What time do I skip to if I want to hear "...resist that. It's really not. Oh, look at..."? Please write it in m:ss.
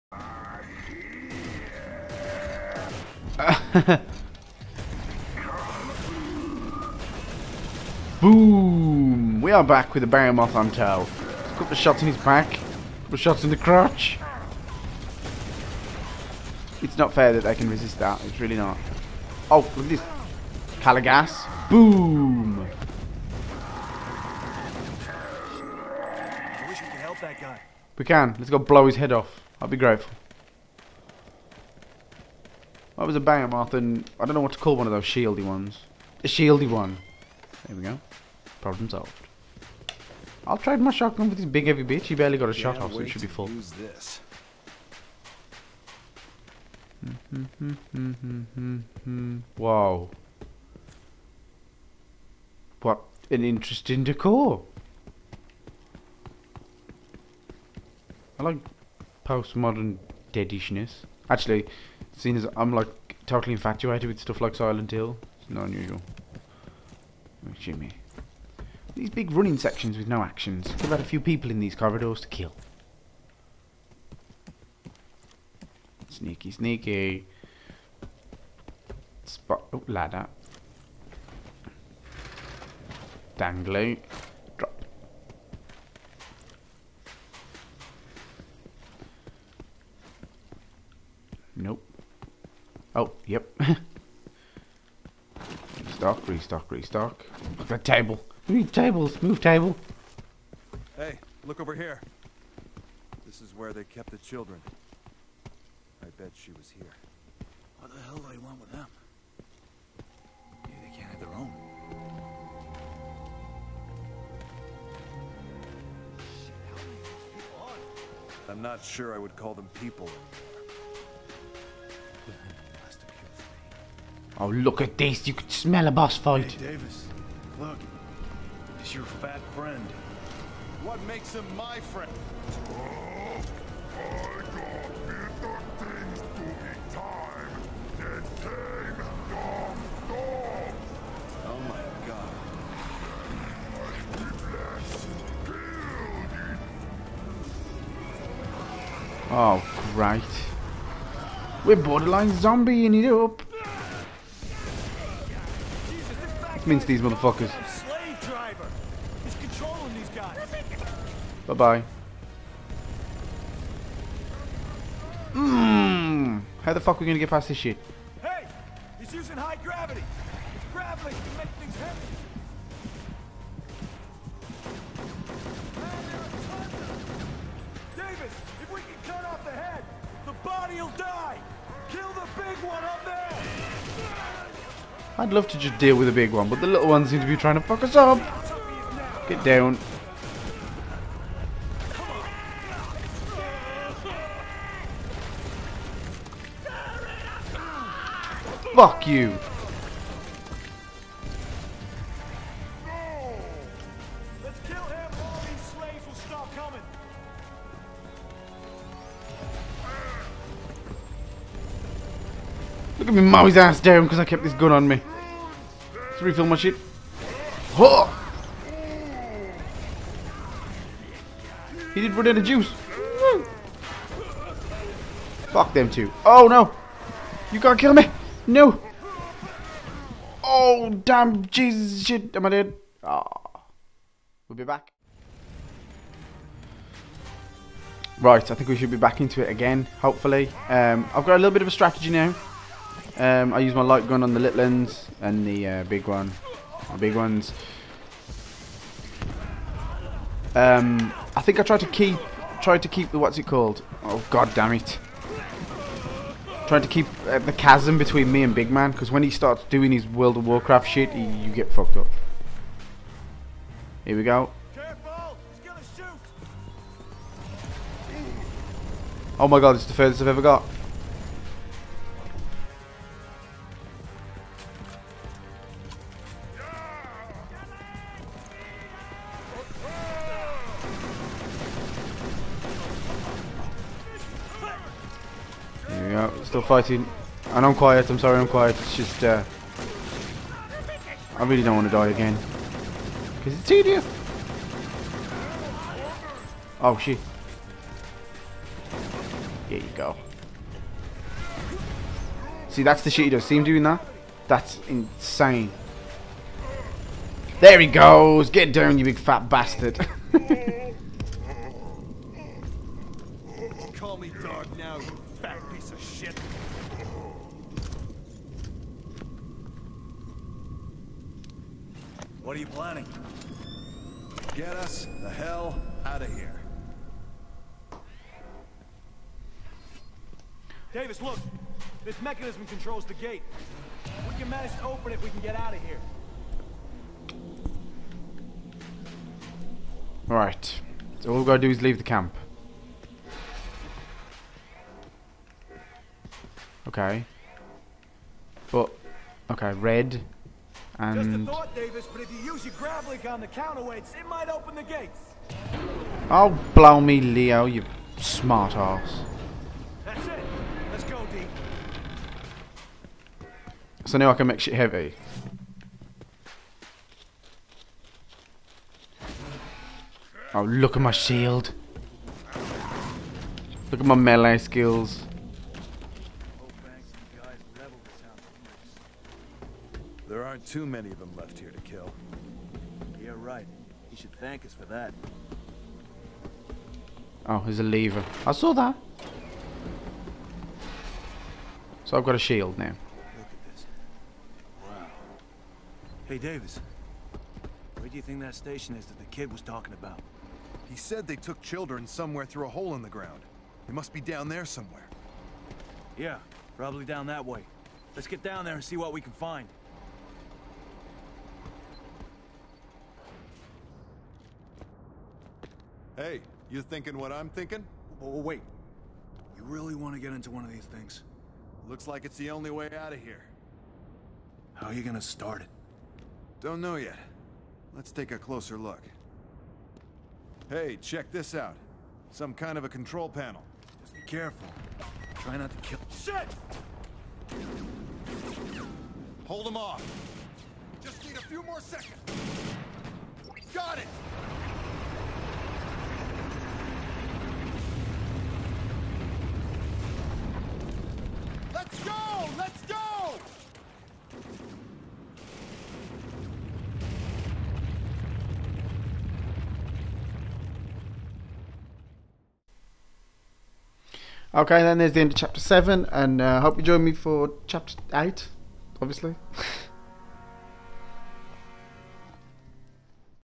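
0:17.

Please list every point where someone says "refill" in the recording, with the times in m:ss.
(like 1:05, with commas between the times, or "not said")
3:36.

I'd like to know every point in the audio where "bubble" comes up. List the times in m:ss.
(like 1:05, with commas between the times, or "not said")
not said.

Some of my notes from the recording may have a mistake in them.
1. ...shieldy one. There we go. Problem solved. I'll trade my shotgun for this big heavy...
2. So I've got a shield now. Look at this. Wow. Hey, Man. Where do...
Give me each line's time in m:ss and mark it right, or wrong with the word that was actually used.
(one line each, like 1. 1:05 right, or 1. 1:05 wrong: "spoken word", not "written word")
1. 0:36 right
2. 6:32 wrong: "Davis", not "Man".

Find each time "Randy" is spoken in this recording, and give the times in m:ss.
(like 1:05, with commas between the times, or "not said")
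not said.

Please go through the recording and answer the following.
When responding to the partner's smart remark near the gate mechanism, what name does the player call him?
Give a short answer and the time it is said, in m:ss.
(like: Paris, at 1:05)
Leo, at 5:57.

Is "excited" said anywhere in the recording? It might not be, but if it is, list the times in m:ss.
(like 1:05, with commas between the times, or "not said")
not said.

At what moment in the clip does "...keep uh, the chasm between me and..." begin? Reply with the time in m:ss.
4:16.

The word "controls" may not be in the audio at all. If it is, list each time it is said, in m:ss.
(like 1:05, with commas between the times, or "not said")
5:32, 7:12.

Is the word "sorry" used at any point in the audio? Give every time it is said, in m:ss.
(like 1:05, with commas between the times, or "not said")
4:48.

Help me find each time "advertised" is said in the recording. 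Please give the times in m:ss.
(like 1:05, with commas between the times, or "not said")
not said.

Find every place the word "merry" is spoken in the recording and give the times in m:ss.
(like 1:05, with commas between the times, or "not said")
not said.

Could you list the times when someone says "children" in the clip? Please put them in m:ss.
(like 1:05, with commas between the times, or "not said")
1:44, 6:41.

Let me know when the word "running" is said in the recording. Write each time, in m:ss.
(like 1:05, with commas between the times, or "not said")
1:09.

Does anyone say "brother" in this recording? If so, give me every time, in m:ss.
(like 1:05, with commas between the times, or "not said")
not said.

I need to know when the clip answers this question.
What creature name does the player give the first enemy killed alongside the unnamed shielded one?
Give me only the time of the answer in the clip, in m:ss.
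0:33.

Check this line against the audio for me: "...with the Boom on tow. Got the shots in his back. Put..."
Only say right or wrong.
wrong.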